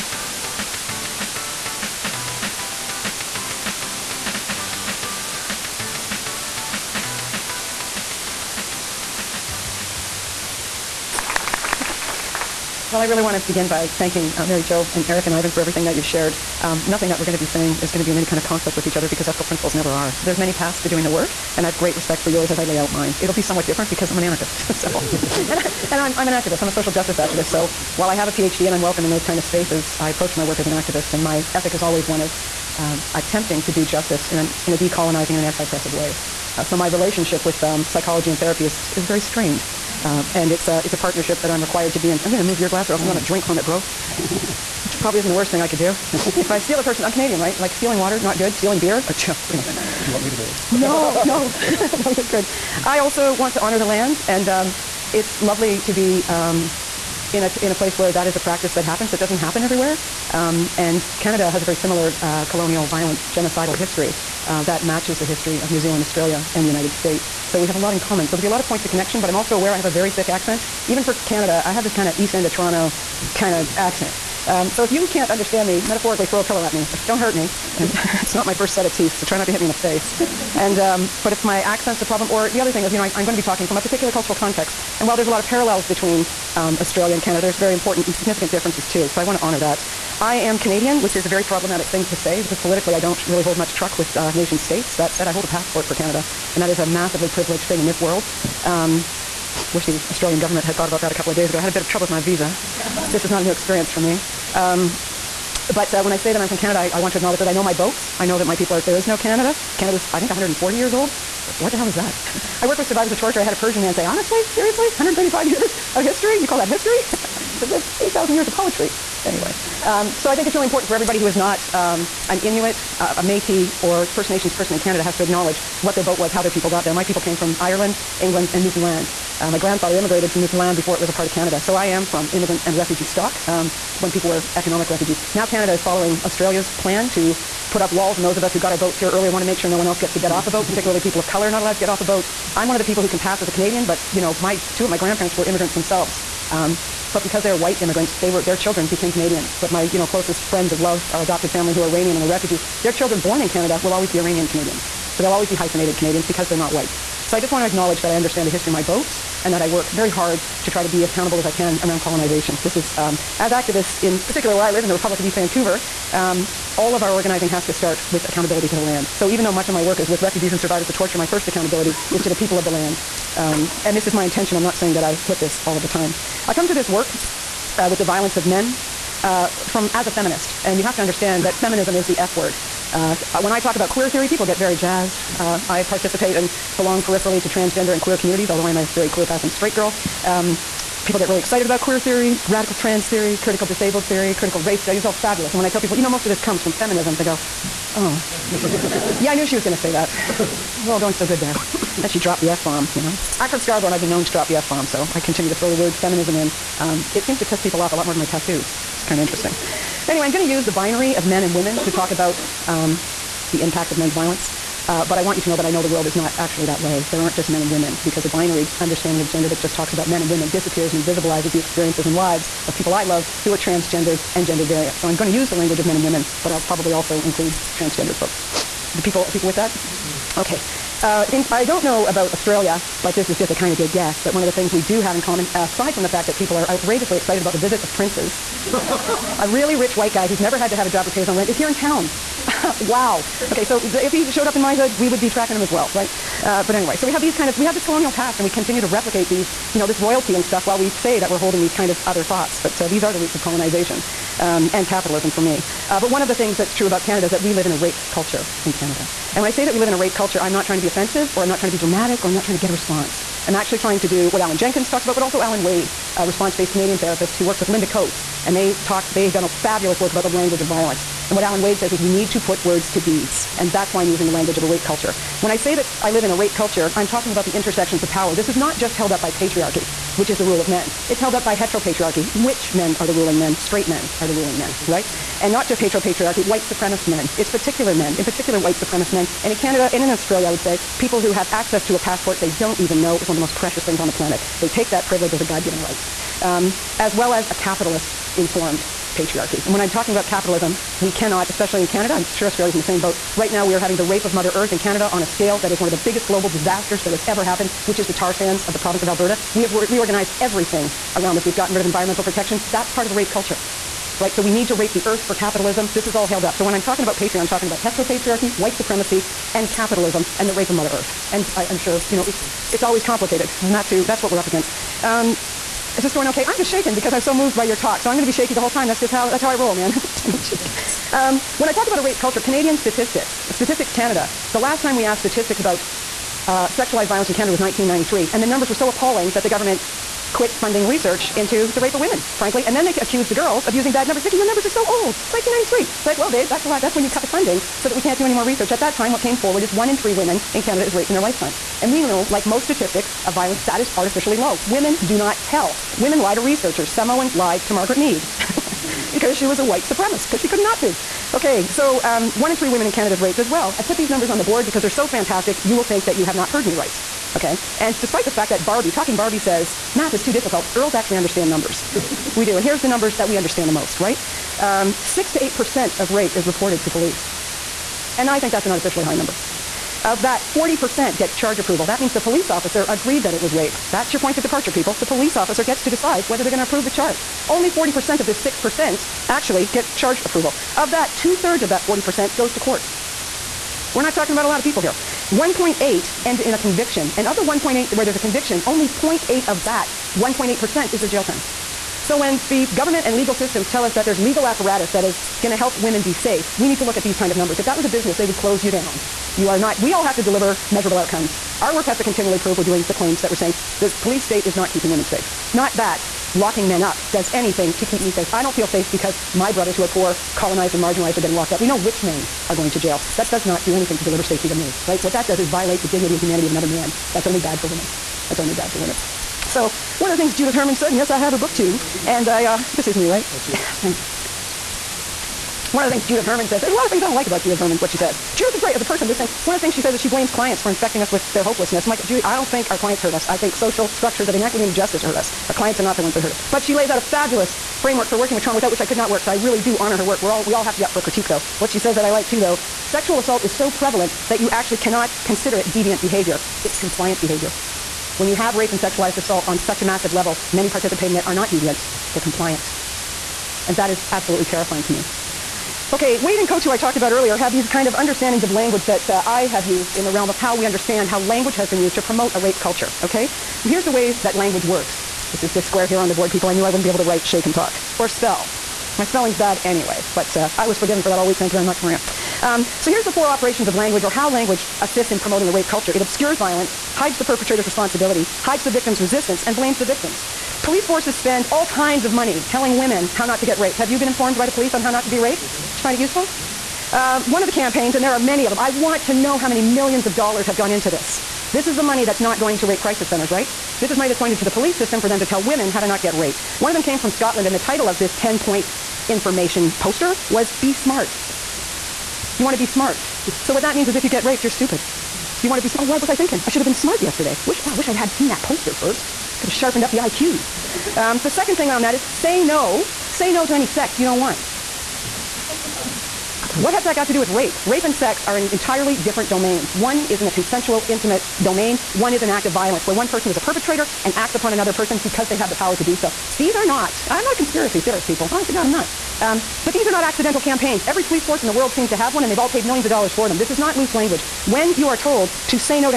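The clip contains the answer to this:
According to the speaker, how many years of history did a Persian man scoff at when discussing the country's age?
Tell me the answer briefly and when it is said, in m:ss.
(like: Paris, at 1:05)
135, at 1:54.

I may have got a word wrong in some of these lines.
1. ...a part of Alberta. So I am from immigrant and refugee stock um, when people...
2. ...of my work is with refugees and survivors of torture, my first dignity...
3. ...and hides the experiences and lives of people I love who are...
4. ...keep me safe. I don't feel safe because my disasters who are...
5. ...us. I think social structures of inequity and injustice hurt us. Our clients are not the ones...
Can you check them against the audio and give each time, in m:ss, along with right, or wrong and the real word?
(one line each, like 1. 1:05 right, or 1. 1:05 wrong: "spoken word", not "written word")
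1. 2:11 wrong: "Canada", not "Alberta"
2. 2:49 wrong: "accountability", not "dignity"
3. 3:40 wrong: "invisibilizes", not "hides"
4. 6:57 wrong: "brothers", not "disasters"
5. 7:23 right.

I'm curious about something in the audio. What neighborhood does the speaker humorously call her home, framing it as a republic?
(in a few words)
East Vancouver.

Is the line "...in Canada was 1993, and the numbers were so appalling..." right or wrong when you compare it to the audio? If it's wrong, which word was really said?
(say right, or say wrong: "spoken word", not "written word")
right.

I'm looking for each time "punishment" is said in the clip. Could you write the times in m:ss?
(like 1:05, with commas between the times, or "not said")
not said.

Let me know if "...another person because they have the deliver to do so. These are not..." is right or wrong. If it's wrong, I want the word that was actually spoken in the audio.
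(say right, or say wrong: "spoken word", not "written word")
wrong: "power", not "deliver".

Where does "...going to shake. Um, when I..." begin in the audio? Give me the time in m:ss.
5:30.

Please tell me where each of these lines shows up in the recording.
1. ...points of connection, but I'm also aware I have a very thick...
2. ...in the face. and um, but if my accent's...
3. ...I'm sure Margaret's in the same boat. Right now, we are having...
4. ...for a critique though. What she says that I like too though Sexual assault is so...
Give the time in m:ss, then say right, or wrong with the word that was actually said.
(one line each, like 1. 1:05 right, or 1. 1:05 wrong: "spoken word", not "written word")
1. 1:08 right
2. 1:19 right
3. 5:02 wrong: "Australia", not "Margaret"
4. 7:30 right.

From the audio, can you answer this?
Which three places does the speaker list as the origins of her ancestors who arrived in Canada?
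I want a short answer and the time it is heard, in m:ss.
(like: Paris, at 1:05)
Ireland, England, and Newfoundland, at 2:07.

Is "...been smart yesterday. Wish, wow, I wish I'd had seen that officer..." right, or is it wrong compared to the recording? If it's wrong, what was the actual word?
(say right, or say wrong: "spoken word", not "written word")
wrong: "poster", not "officer".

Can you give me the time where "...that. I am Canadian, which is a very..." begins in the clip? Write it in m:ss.
1:29.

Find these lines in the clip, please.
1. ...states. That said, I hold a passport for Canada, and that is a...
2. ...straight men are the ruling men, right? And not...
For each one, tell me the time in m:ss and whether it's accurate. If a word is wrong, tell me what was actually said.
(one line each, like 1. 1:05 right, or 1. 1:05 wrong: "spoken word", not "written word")
1. 1:34 right
2. 4:43 right.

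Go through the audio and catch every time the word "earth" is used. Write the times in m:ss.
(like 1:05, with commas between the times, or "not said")
5:04, 5:15, 5:20.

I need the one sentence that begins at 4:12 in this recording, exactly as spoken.
But uh, these are the roots of colonization um, and capitalism for me.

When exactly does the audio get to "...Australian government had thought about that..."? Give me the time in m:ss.
1:40.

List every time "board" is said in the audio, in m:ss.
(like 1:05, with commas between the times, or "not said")
6:04, 7:56.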